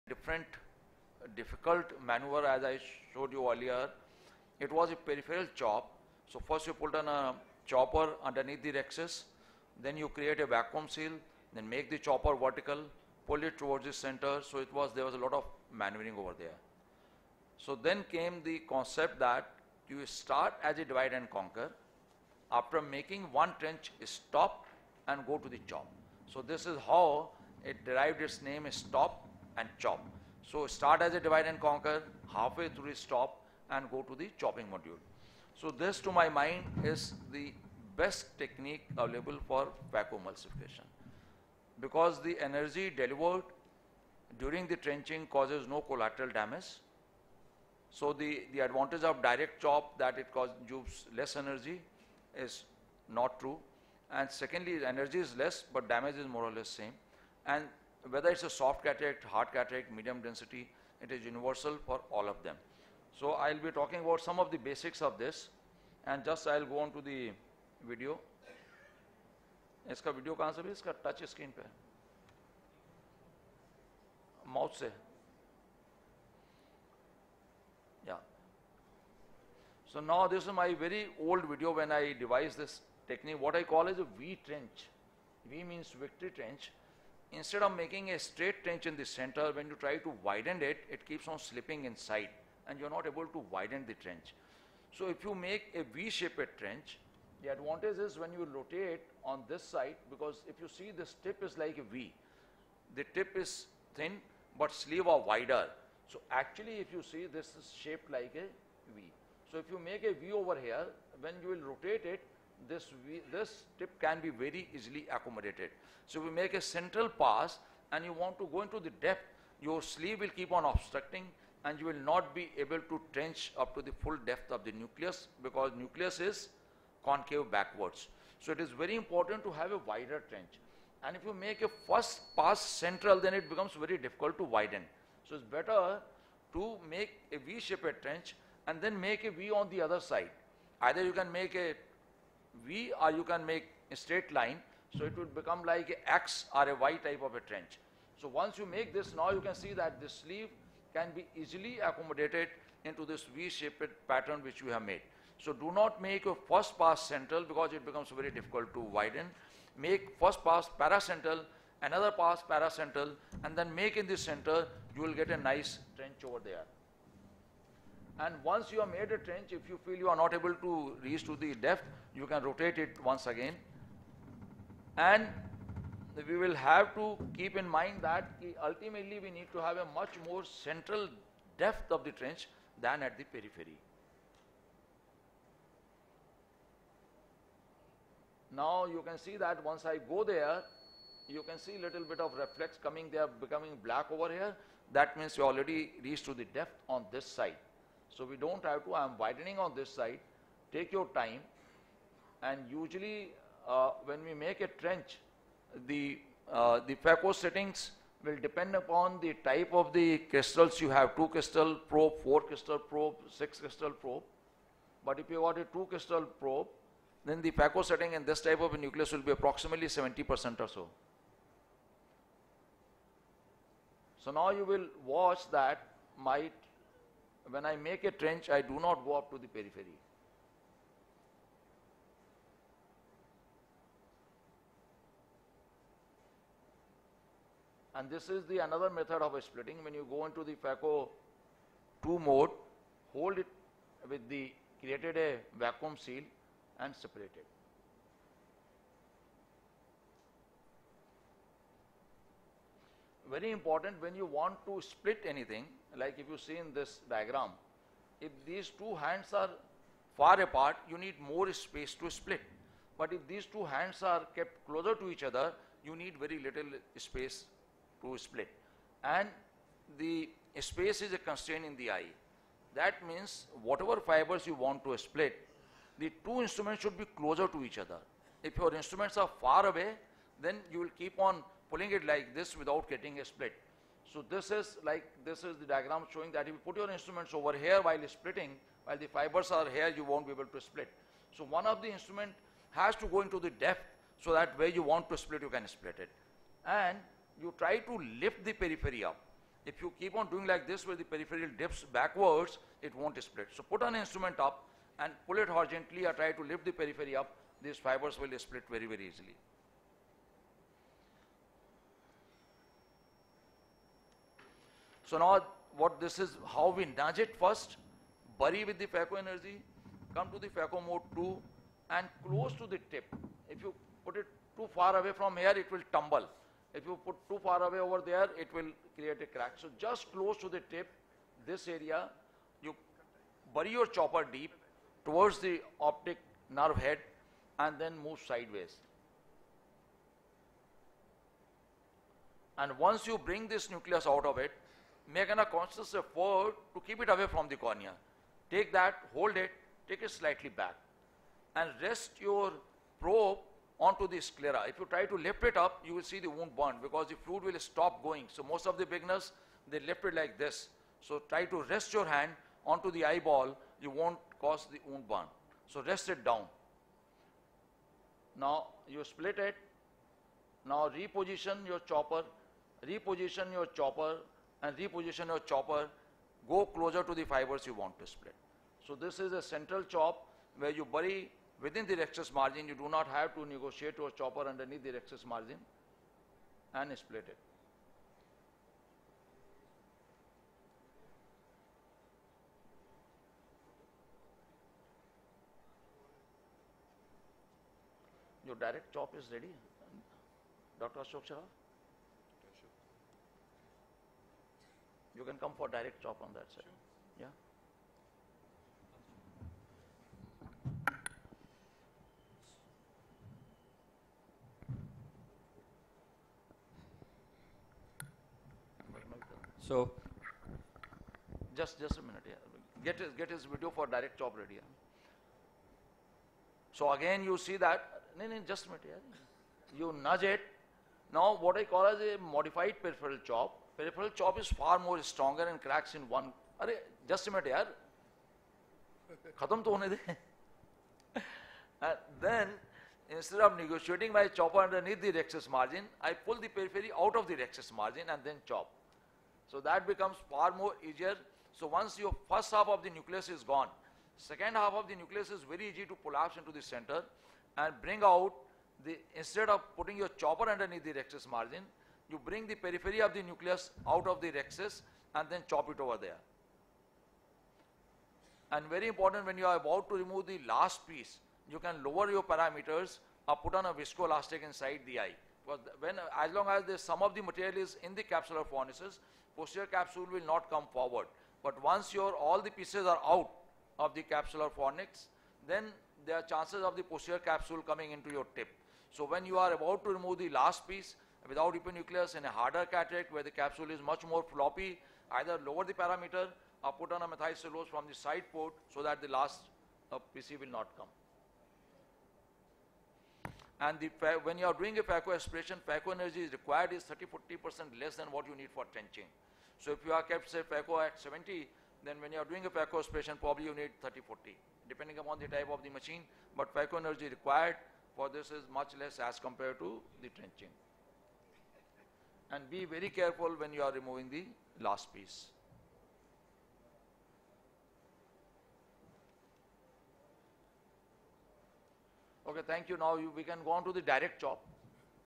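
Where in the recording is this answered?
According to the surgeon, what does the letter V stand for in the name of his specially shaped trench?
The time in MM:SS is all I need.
01:25.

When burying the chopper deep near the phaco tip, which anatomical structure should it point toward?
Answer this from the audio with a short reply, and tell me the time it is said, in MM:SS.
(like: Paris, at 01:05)
optic nerve head, at 05:35.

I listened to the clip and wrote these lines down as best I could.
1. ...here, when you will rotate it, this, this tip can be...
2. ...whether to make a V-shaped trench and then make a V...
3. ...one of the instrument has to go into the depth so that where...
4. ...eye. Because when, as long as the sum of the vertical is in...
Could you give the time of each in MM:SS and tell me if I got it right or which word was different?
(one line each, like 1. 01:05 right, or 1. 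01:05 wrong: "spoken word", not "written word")
1. 01:50 right
2. 02:15 wrong: "better", not "whether"
3. 04:51 right
4. 07:54 wrong: "material", not "vertical".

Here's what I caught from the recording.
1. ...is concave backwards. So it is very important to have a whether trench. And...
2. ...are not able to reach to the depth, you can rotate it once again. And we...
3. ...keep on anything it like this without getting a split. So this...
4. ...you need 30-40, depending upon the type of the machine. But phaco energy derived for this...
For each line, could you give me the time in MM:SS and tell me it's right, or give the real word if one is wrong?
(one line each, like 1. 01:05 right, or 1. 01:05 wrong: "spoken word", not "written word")
1. 02:06 wrong: "wider", not "whether"
2. 02:50 right
3. 04:40 wrong: "pulling", not "anything"
4. 08:33 wrong: "required", not "derived".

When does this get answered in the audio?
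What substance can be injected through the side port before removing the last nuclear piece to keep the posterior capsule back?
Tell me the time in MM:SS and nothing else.
08:17.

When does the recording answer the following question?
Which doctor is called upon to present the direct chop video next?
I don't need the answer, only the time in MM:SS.
06:40.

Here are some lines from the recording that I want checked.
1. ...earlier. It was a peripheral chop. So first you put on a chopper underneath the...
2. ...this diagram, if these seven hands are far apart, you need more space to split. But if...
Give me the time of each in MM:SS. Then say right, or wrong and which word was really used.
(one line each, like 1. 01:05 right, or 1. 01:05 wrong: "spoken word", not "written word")
1. 00:03 right
2. 04:16 wrong: "two", not "seven".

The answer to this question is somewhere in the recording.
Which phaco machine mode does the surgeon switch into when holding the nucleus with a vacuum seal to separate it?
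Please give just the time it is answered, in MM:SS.
04:00.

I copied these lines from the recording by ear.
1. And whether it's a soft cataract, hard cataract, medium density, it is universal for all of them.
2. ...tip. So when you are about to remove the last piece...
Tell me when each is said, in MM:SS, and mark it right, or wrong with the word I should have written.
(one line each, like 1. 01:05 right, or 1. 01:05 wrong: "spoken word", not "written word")
1. 00:57 right
2. 08:08 right.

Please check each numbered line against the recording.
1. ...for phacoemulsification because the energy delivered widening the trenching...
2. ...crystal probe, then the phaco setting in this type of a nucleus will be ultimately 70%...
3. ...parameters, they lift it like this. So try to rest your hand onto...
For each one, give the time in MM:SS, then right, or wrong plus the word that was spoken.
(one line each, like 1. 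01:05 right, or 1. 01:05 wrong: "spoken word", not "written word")
1. 00:39 wrong: "during", not "widening"
2. 03:35 wrong: "approximately", not "ultimately"
3. 05:58 wrong: "beginners", not "parameters".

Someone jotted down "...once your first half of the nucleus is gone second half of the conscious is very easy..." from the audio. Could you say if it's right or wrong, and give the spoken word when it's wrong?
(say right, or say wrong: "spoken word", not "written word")
wrong: "nucleus", not "conscious".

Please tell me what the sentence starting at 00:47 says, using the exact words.
So the, the advantage of direct chop that it causes less energy is not true.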